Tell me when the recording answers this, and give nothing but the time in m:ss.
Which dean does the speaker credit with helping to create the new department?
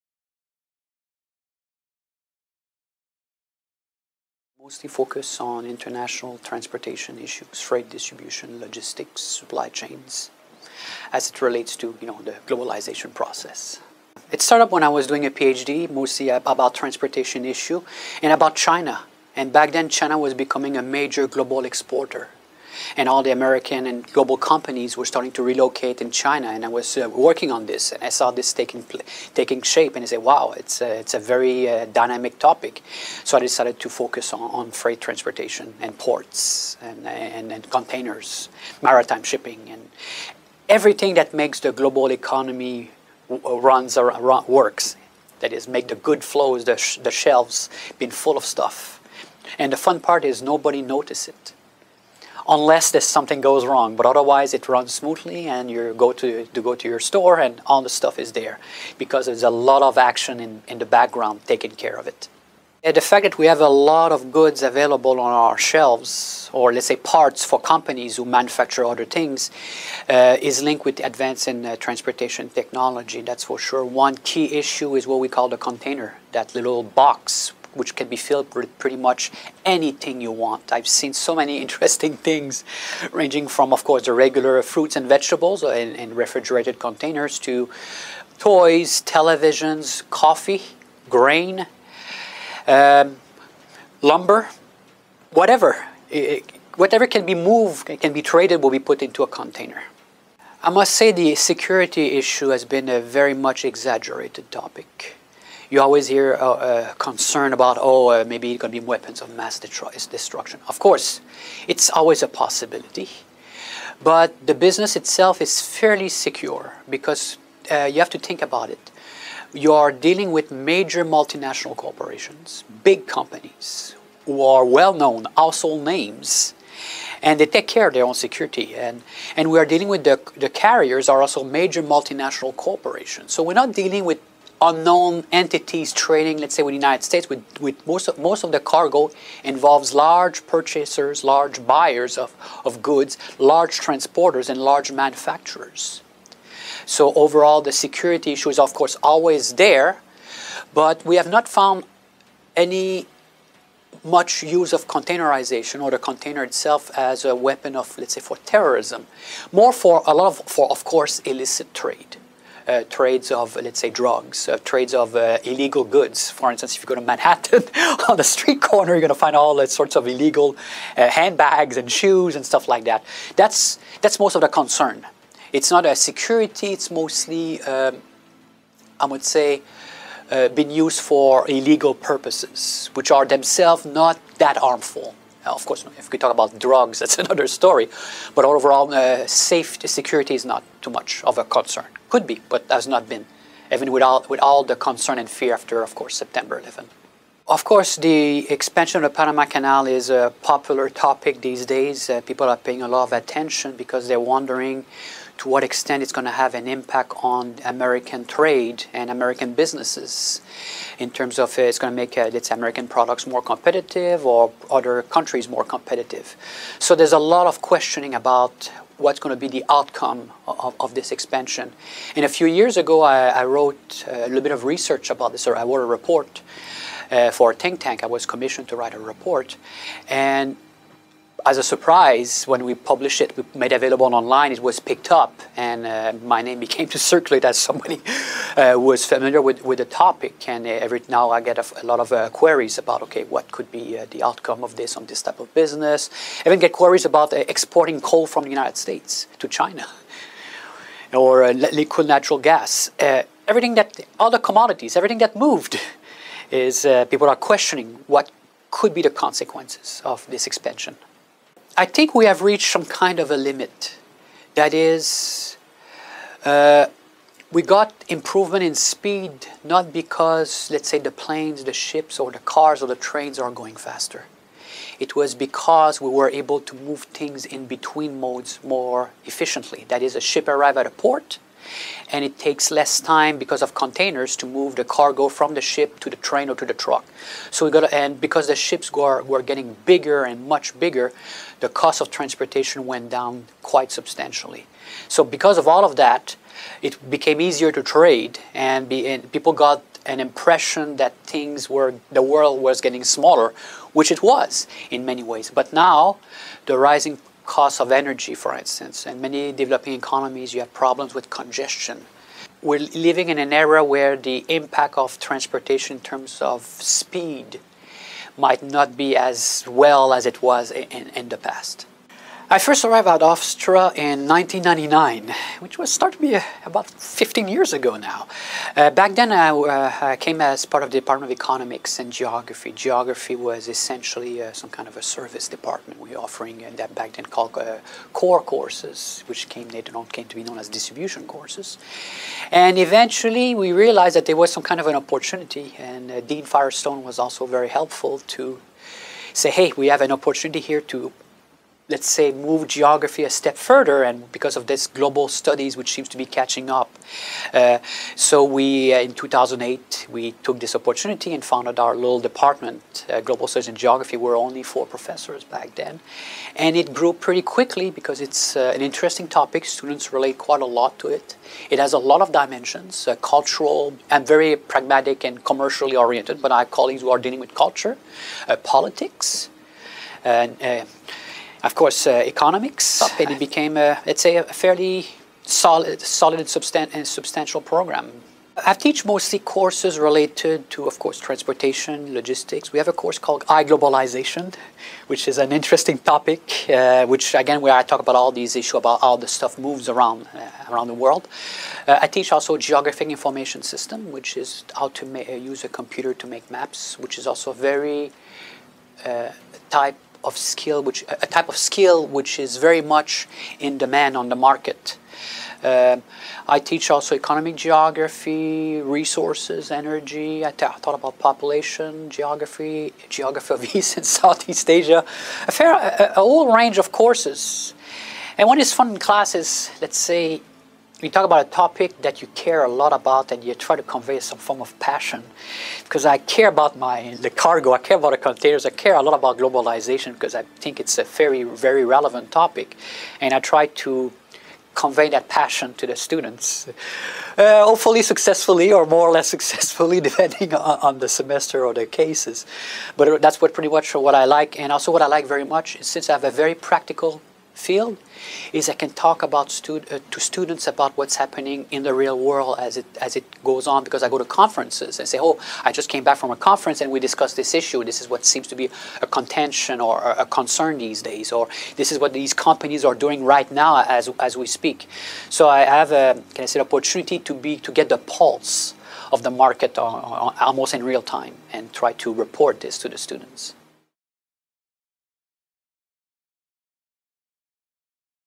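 5:46.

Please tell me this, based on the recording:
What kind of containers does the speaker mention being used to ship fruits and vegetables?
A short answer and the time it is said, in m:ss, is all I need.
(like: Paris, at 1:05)
refrigerated containers, at 1:26.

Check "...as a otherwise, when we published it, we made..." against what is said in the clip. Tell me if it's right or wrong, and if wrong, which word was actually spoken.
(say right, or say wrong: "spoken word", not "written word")
wrong: "surprise", not "otherwise".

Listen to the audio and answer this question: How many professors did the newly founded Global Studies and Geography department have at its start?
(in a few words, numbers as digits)
4.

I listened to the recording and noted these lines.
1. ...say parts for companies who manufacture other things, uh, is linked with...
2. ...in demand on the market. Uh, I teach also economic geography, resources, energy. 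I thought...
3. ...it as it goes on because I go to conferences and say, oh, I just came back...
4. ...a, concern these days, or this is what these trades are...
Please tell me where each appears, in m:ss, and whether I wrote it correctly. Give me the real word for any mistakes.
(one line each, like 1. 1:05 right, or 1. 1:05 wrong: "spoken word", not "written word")
1. 1:06 right
2. 6:53 right
3. 7:42 right
4. 7:50 wrong: "companies", not "trades".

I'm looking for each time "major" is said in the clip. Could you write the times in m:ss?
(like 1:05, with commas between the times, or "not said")
0:20, 2:00, 2:11.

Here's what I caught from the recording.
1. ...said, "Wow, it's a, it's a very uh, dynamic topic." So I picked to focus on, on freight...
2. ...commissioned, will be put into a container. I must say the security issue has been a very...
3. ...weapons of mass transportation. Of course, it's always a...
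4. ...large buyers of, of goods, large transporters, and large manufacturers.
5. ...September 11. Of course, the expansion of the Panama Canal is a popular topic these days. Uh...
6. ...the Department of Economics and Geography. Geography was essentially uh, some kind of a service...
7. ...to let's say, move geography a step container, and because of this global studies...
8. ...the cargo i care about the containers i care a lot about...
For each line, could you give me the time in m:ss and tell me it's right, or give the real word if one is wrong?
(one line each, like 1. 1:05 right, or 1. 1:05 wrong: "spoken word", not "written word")
1. 0:30 wrong: "decided", not "picked"
2. 1:38 wrong: "traded", not "commissioned"
3. 1:48 wrong: "destruction", not "transportation"
4. 2:21 right
5. 3:16 right
6. 5:30 right
7. 5:50 wrong: "further", not "container"
8. 7:17 right.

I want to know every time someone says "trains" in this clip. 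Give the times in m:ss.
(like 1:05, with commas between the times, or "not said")
4:33, 4:46.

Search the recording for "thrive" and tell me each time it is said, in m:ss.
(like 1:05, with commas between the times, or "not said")
not said.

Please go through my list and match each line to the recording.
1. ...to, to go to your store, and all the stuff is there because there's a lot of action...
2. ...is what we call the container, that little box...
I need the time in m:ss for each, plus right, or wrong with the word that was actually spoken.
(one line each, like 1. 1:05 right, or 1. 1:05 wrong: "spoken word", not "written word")
1. 0:56 right
2. 1:14 right.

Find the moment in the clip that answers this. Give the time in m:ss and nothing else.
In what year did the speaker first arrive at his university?
5:24.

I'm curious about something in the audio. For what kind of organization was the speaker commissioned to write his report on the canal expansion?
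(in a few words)
a think tank.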